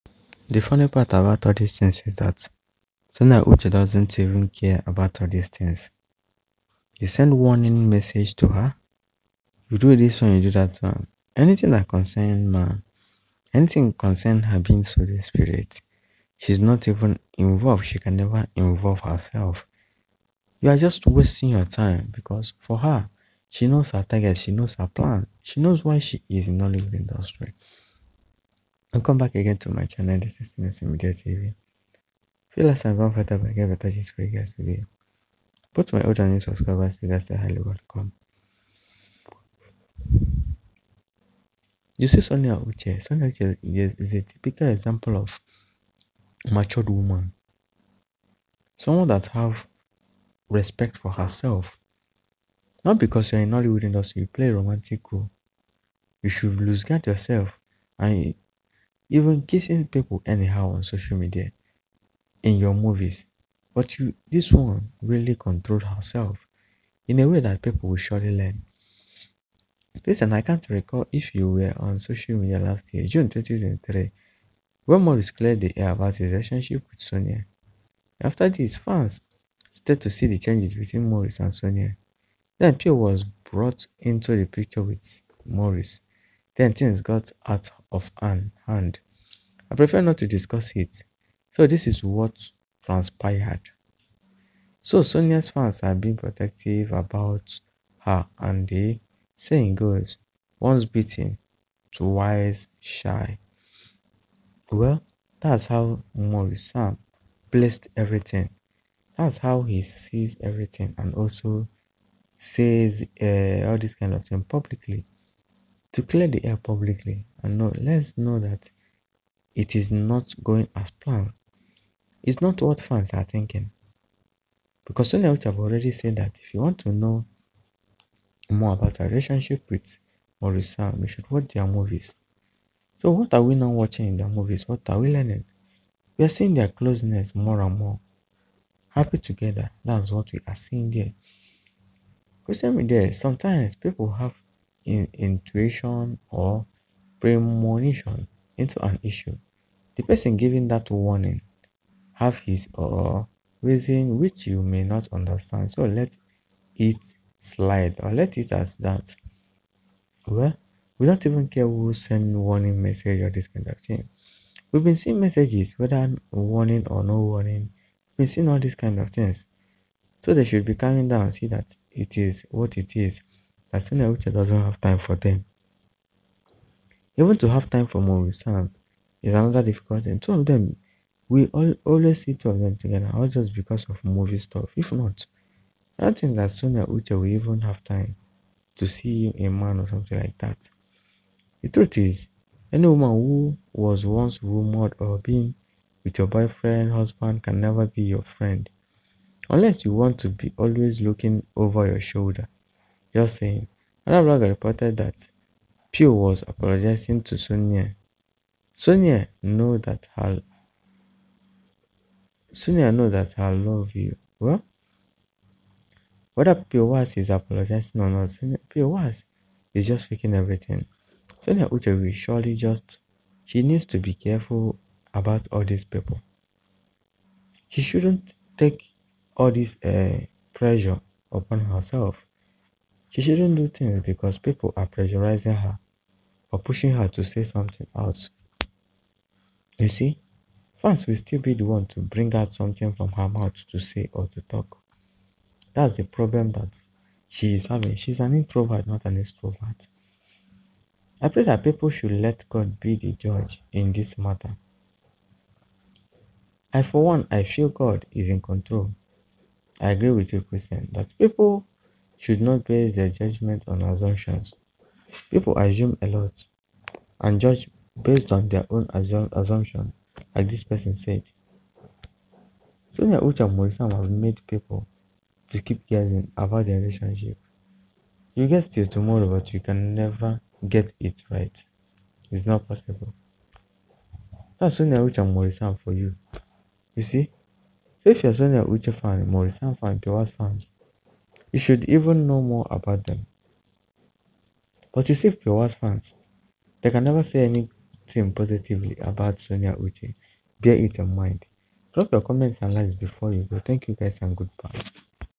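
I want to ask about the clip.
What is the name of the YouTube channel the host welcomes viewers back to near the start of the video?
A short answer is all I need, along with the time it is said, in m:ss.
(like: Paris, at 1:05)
Nelson Media TV, at 0:30.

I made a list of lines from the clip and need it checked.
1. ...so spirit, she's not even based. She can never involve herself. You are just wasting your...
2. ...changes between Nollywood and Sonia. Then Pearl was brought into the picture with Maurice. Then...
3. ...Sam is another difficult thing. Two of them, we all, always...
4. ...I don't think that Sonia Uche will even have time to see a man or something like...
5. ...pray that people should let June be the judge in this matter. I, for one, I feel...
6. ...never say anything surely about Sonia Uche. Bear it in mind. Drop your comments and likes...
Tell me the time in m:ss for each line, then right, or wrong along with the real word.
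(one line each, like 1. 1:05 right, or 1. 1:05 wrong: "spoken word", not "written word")
1. 0:14 wrong: "involved", not "based"
2. 1:20 wrong: "Maurice", not "Nollywood"
3. 2:58 right
4. 3:05 right
5. 4:11 wrong: "God", not "June"
6. 4:57 wrong: "positively", not "surely".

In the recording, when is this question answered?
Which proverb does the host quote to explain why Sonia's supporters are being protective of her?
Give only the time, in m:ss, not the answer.
1:40.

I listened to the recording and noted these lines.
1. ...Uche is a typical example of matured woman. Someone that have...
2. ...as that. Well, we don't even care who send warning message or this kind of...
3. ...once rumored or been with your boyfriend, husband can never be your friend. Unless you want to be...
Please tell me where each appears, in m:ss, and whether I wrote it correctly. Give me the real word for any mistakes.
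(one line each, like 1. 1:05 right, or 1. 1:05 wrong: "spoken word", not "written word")
1. 0:43 right
2. 2:38 right
3. 3:14 right.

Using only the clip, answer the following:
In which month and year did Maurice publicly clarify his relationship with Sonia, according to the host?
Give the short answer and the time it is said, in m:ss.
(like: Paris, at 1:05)
June 2023, at 1:13.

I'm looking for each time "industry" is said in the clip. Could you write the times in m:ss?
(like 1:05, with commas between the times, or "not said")
0:26, 0:53.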